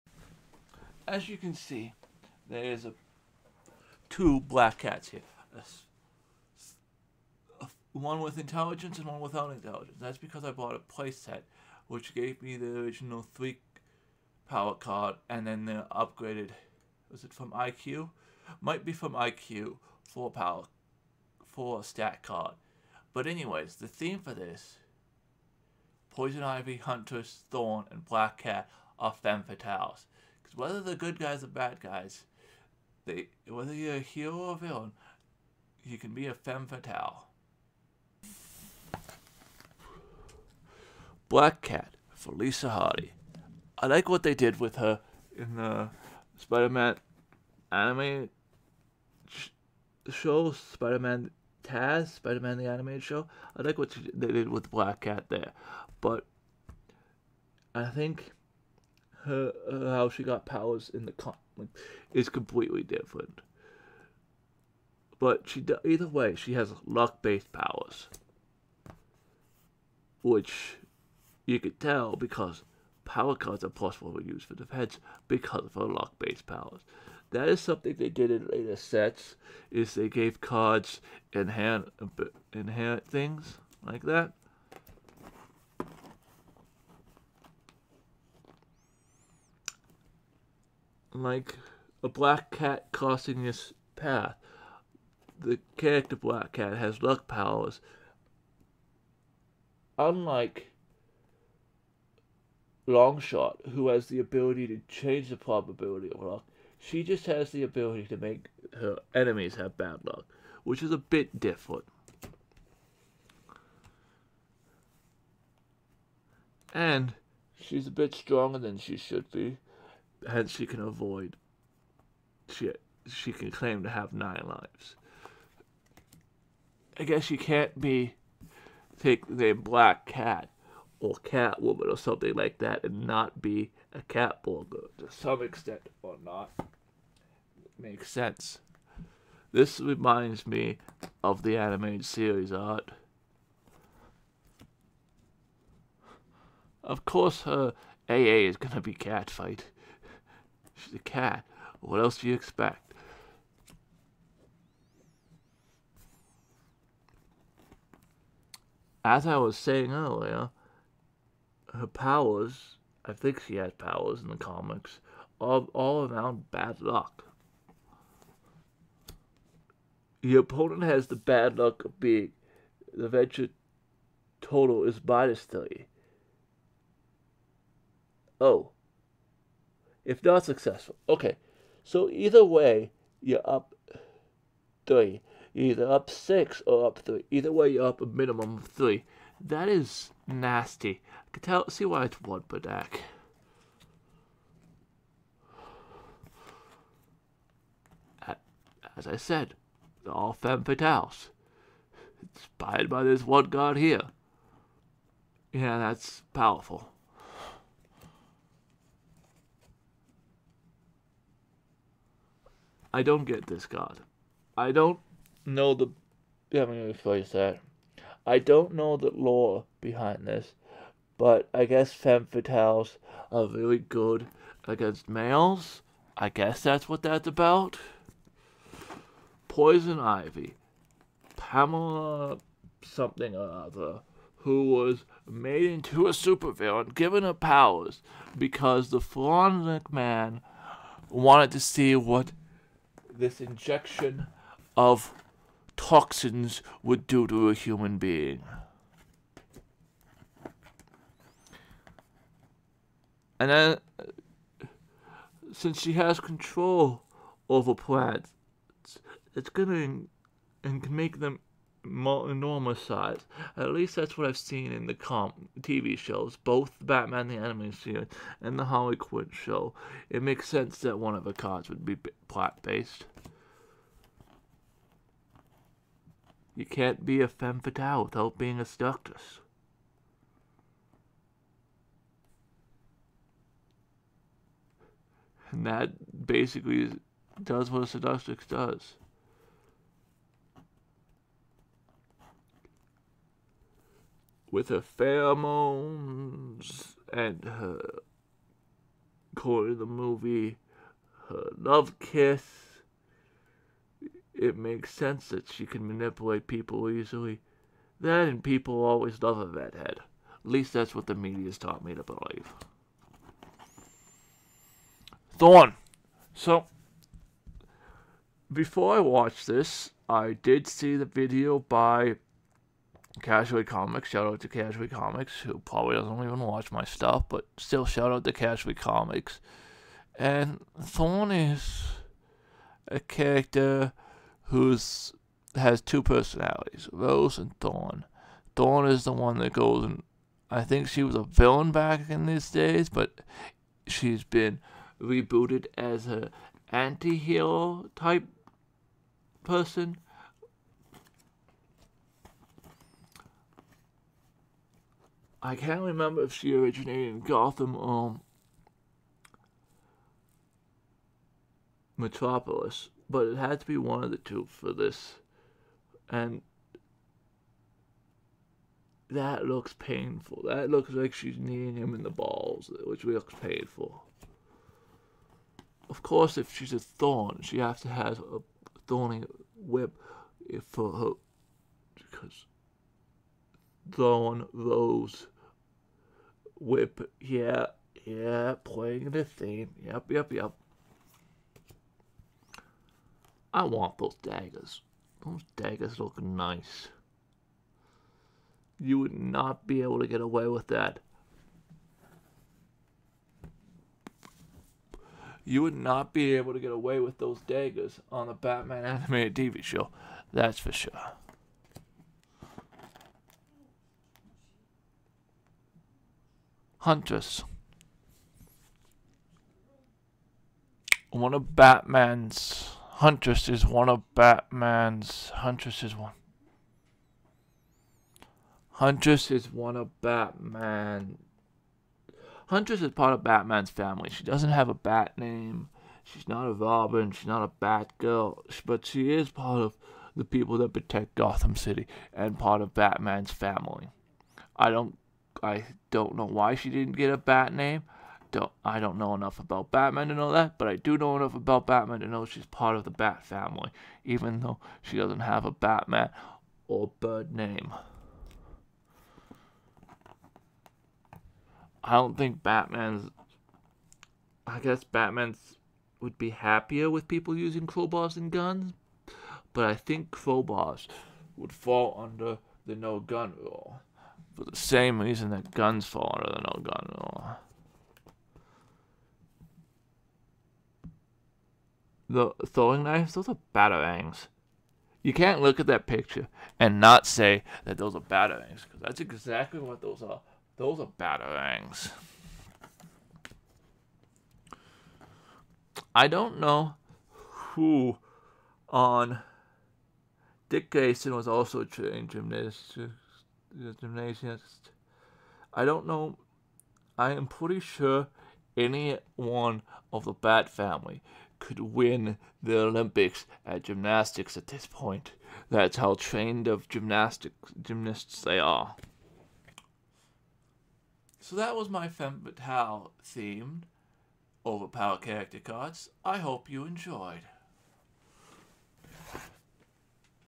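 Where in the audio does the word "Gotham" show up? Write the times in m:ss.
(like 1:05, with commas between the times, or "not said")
5:57, 7:21.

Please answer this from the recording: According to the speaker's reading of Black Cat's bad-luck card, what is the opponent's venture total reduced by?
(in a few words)
3.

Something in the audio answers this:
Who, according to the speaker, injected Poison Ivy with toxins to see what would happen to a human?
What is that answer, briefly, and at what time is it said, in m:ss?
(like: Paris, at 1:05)
Floronic Man, at 3:58.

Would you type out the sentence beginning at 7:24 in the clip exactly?
I don't I don't know why she didn't get a bat name.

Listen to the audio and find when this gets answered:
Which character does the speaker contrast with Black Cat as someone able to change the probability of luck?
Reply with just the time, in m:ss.
1:42.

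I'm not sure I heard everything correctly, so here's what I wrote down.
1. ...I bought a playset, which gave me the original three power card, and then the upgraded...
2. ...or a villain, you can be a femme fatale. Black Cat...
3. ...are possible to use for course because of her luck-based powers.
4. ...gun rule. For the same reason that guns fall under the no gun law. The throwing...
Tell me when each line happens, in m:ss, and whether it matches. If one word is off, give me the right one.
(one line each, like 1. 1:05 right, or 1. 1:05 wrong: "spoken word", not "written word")
1. 0:10 right
2. 0:34 right
3. 1:13 wrong: "defense", not "course"
4. 7:52 right.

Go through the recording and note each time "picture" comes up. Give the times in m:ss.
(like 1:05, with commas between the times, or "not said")
8:05.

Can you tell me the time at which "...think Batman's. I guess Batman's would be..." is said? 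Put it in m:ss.
7:42.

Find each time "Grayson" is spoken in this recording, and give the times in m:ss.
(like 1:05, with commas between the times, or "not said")
8:20.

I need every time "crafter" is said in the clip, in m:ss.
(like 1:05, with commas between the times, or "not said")
not said.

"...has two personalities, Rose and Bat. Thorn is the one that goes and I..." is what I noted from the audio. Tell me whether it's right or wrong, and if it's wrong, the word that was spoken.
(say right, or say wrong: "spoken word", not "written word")
wrong: "Thorn", not "Bat".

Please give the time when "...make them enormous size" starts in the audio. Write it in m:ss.
4:20.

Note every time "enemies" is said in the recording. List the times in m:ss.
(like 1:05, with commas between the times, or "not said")
1:49.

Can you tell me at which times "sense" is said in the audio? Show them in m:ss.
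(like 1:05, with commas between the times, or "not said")
2:18, 4:30, 5:04.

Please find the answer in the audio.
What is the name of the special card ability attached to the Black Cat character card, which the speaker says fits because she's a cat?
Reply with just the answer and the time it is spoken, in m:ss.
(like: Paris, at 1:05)
Cat fight, at 2:28.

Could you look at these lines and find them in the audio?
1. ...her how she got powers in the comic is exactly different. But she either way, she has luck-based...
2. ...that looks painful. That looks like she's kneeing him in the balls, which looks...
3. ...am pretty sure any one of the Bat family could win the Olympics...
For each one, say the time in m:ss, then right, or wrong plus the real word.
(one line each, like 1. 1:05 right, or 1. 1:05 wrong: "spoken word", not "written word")
1. 0:59 wrong: "completely", not "exactly"
2. 6:09 right
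3. 8:27 right.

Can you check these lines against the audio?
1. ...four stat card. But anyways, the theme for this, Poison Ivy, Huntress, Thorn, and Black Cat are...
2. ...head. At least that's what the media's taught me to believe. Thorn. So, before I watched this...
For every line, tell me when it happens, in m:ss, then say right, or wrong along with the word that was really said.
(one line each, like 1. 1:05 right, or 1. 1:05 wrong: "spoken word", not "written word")
1. 0:21 right
2. 5:09 right.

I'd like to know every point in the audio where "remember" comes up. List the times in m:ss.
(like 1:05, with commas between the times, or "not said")
5:55.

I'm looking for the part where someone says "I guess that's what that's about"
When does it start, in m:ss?
3:46.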